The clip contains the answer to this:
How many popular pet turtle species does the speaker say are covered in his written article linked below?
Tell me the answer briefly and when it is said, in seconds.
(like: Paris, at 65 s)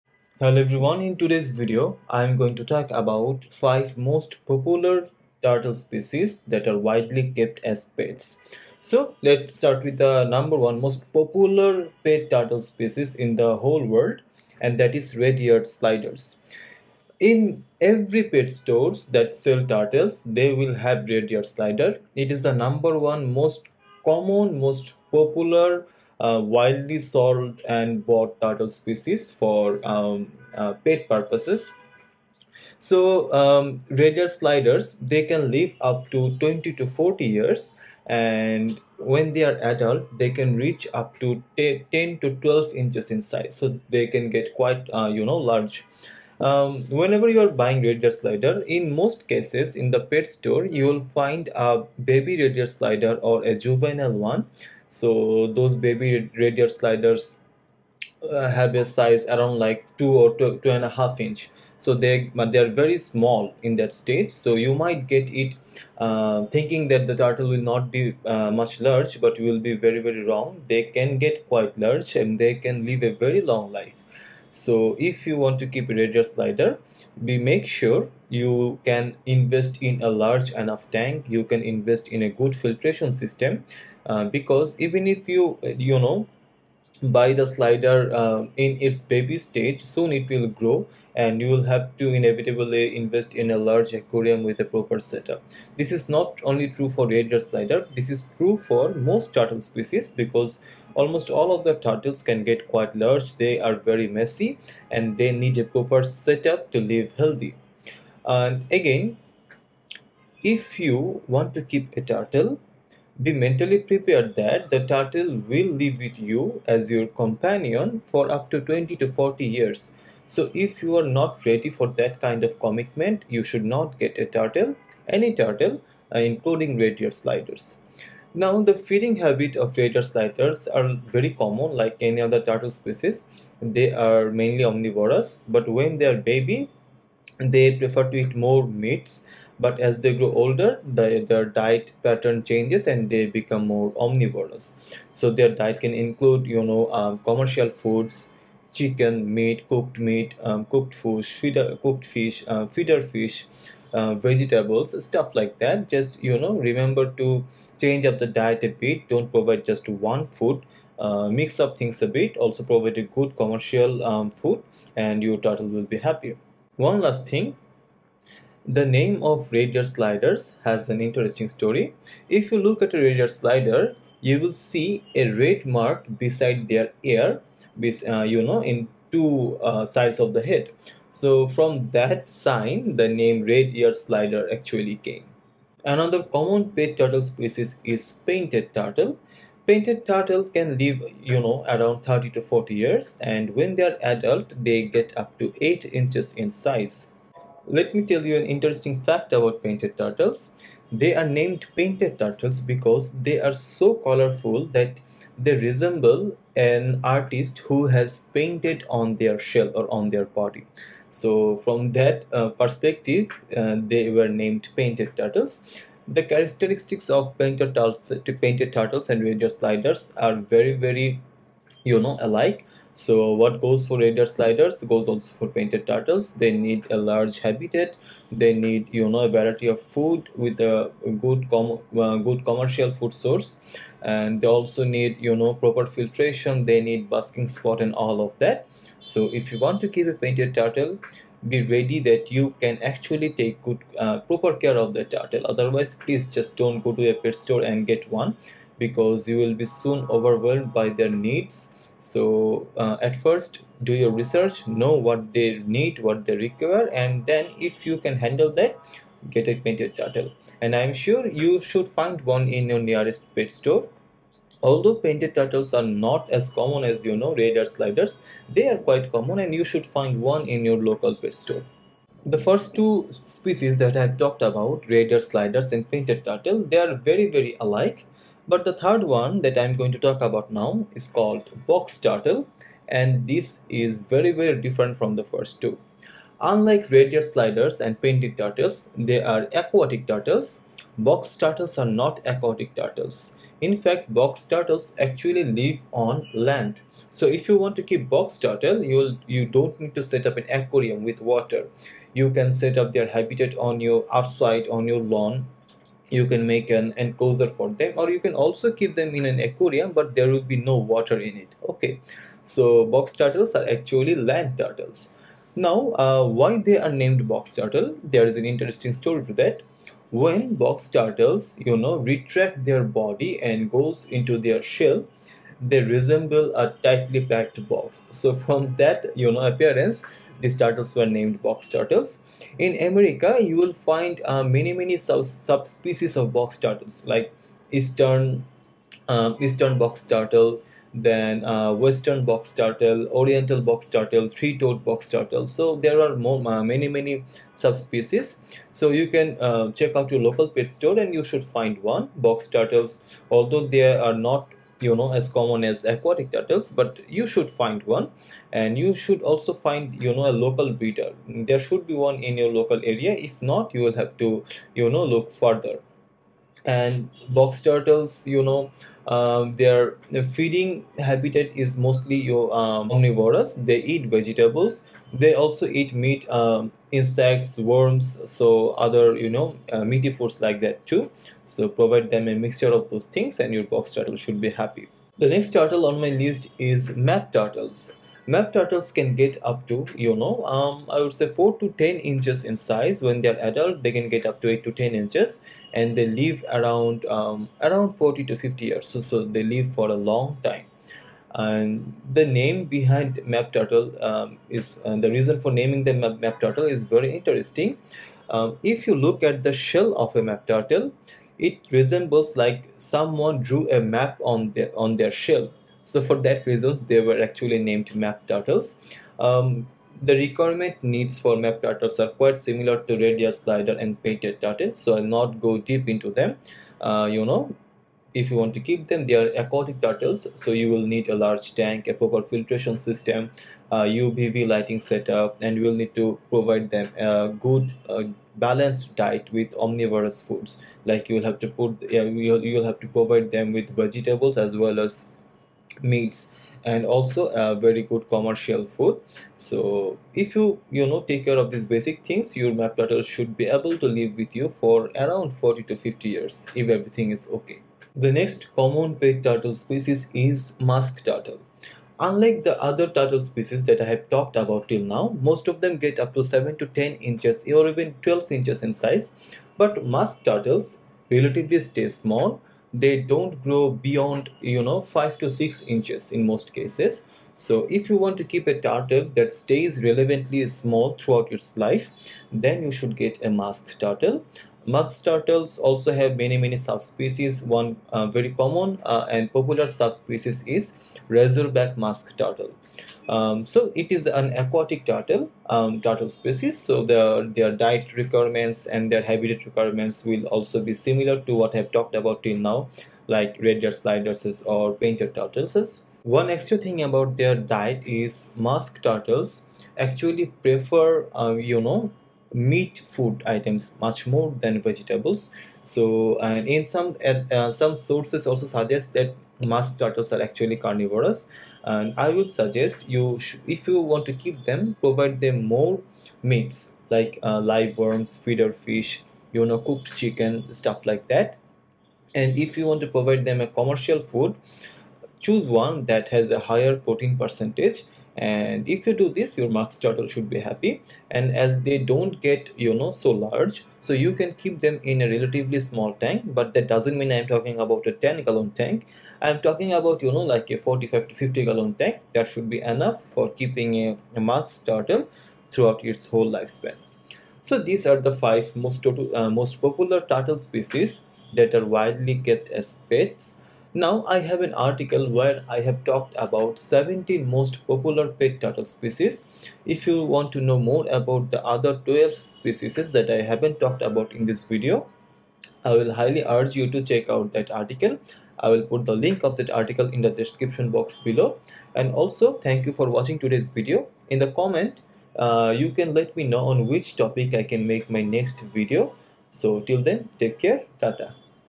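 17, at 566 s.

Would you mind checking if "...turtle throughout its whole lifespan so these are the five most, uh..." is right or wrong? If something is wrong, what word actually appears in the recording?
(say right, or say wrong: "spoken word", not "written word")
right.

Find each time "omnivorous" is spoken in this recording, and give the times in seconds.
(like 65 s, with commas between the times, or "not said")
134 s, 144 s, 372 s, 439 s.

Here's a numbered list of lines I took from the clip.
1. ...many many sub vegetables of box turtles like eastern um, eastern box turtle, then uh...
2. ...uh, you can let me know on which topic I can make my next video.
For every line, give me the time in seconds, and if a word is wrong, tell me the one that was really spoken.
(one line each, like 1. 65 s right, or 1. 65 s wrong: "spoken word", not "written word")
1. 334 s wrong: "subspecies", not "vegetables"
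2. 585 s right.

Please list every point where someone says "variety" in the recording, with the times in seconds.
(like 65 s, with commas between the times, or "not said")
229 s.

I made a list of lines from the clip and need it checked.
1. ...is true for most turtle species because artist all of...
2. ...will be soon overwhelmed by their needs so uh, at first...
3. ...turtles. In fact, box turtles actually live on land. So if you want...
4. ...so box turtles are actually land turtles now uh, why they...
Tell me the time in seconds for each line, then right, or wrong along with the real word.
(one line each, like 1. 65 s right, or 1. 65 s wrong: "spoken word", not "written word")
1. 98 s wrong: "almost", not "artist"
2. 249 s right
3. 292 s right
4. 312 s right.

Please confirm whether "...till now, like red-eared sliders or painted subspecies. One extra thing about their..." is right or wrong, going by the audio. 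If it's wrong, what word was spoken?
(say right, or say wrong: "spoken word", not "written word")
wrong: "turtles", not "subspecies".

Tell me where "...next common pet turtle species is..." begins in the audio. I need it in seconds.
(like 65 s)
458 s.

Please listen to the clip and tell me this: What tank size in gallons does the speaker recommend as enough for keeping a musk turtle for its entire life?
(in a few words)
45 to 50 gallons.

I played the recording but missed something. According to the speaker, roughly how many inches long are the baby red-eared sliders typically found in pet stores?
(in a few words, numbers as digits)
2.5 inches.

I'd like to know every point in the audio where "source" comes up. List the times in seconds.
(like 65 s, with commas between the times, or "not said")
233 s, 517 s.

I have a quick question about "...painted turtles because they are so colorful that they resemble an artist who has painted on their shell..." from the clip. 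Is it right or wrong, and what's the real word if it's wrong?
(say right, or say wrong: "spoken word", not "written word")
right.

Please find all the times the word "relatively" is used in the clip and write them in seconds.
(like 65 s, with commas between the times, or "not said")
471 s, 545 s.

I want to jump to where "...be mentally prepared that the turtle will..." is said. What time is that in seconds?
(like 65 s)
113 s.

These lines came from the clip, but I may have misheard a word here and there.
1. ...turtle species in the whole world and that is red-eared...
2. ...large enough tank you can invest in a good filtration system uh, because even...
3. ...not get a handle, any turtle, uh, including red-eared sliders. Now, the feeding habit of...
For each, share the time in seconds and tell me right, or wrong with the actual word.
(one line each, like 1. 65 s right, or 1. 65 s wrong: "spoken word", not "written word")
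1. 12 s right
2. 80 s right
3. 123 s wrong: "turtle", not "handle".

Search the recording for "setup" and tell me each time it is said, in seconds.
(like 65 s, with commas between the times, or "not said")
94 s, 106 s, 434 s.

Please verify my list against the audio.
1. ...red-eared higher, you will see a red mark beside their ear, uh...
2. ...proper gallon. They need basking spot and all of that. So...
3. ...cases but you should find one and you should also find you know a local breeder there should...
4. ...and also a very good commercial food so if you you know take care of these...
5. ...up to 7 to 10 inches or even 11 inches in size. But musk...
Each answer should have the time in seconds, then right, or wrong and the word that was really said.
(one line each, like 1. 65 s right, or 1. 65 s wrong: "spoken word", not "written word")
1. 173 s wrong: "slider", not "higher"
2. 235 s wrong: "filtration", not "gallon"
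3. 356 s wrong: "turtles", not "cases"
4. 446 s right
5. 465 s wrong: "12", not "11".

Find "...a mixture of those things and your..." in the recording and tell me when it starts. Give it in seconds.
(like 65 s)
382 s.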